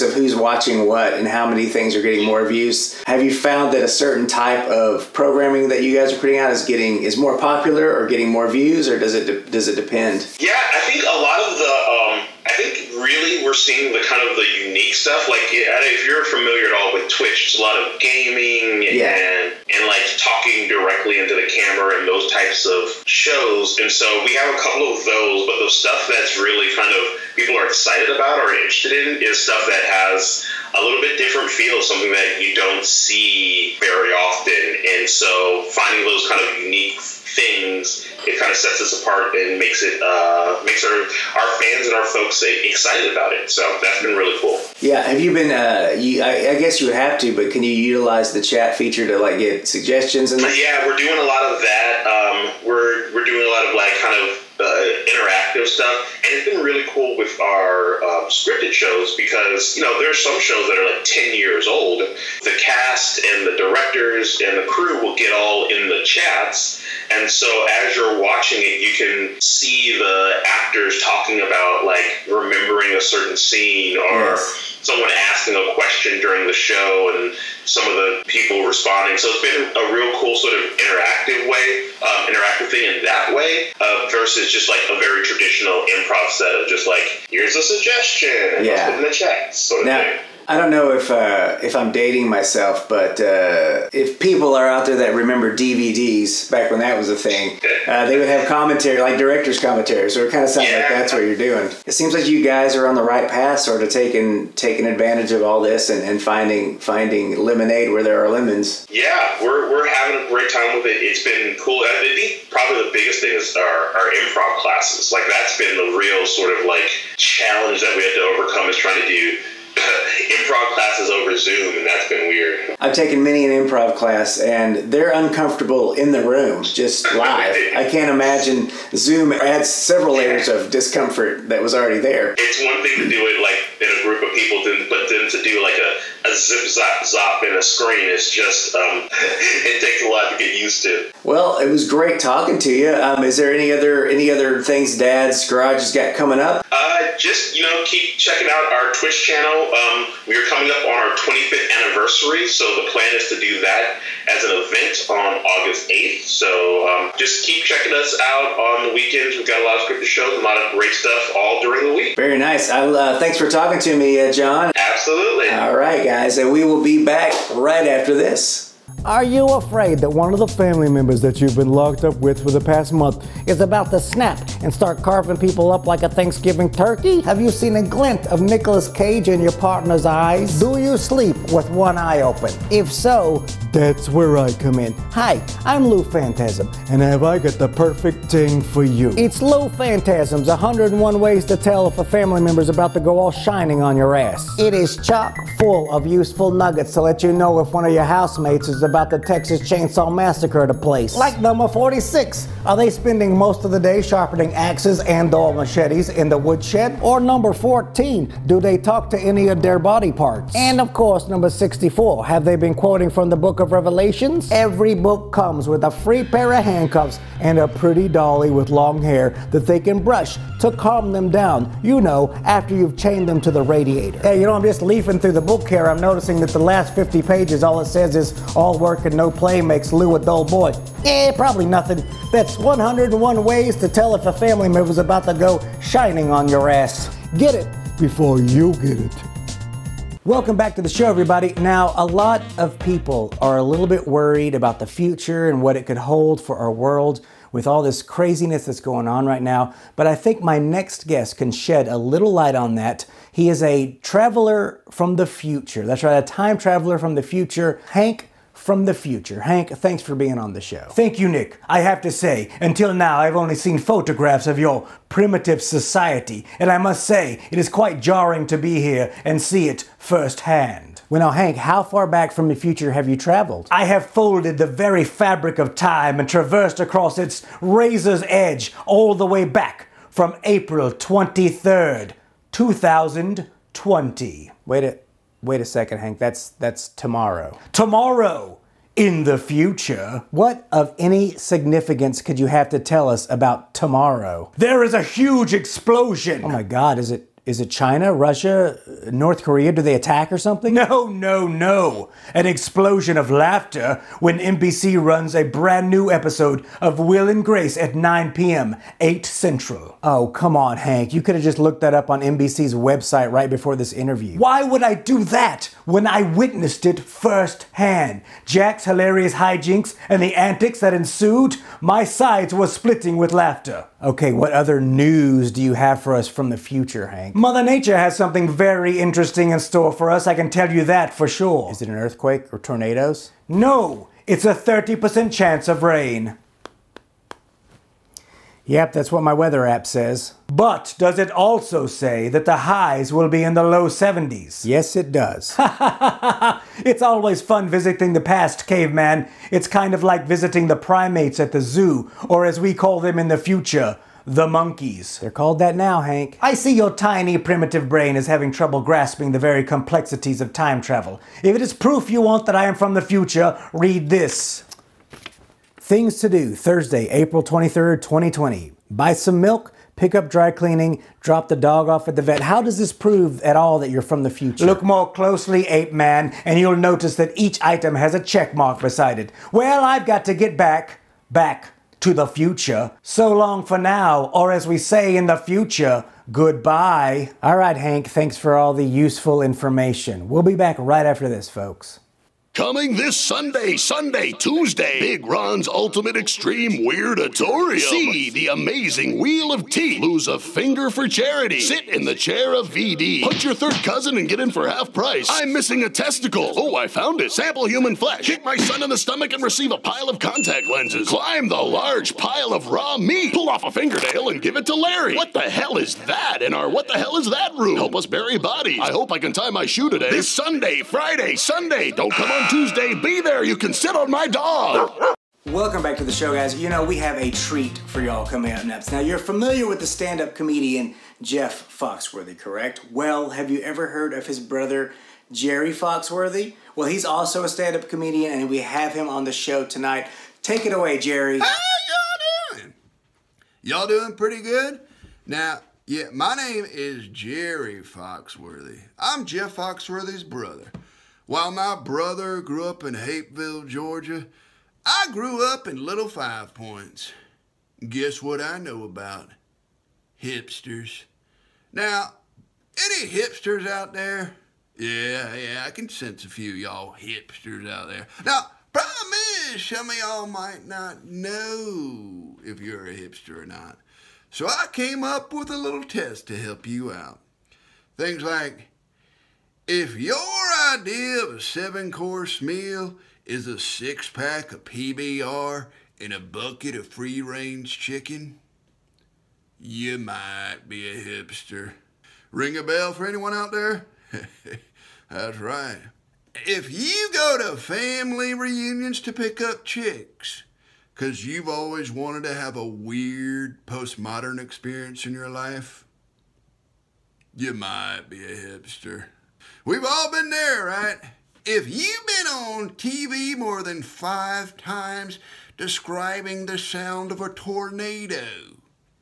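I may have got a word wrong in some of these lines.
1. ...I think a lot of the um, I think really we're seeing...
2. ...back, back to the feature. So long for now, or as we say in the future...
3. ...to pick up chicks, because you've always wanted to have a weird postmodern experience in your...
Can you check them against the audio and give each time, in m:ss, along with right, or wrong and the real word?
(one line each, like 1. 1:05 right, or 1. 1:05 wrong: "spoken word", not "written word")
1. 0:10 right
2. 6:20 wrong: "future", not "feature"
3. 8:19 right.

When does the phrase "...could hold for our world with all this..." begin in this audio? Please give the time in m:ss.
4:05.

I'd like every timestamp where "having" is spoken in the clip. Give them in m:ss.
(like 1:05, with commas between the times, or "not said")
1:49, 5:58.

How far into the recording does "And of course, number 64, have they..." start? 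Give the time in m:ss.
3:30.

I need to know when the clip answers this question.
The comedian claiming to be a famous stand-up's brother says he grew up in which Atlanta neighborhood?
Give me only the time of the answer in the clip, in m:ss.
7:35.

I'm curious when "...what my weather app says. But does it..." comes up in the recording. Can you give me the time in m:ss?
5:39.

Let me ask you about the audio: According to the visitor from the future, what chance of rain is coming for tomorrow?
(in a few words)
30%.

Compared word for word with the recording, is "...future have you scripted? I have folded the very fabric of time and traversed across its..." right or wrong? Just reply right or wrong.
wrong.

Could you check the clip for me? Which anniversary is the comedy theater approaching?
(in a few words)
25th.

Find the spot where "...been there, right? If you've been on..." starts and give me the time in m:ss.
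8:30.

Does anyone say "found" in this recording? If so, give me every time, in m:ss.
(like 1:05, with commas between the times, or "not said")
0:03, 6:46.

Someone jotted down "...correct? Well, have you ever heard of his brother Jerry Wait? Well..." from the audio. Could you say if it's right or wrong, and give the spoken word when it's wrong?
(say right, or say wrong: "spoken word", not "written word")
wrong: "Foxworthy", not "Wait".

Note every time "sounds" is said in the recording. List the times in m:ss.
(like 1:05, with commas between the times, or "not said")
1:40, 8:36.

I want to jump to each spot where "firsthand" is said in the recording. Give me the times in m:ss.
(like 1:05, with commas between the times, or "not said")
4:29, 5:16.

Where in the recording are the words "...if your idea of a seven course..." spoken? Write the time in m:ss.
7:59.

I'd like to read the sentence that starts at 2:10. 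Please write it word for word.
of discomfort that was already there.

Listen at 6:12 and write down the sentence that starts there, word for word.
How does this prove at all that you're from the future?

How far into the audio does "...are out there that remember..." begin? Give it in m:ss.
1:34.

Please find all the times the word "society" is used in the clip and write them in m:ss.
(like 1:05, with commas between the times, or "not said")
4:25.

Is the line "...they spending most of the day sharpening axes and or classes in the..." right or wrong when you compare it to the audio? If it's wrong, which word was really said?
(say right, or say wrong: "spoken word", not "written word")
wrong: "machetes", not "classes".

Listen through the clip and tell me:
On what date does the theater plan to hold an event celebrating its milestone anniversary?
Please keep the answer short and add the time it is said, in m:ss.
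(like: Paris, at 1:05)
August 8th, at 2:35.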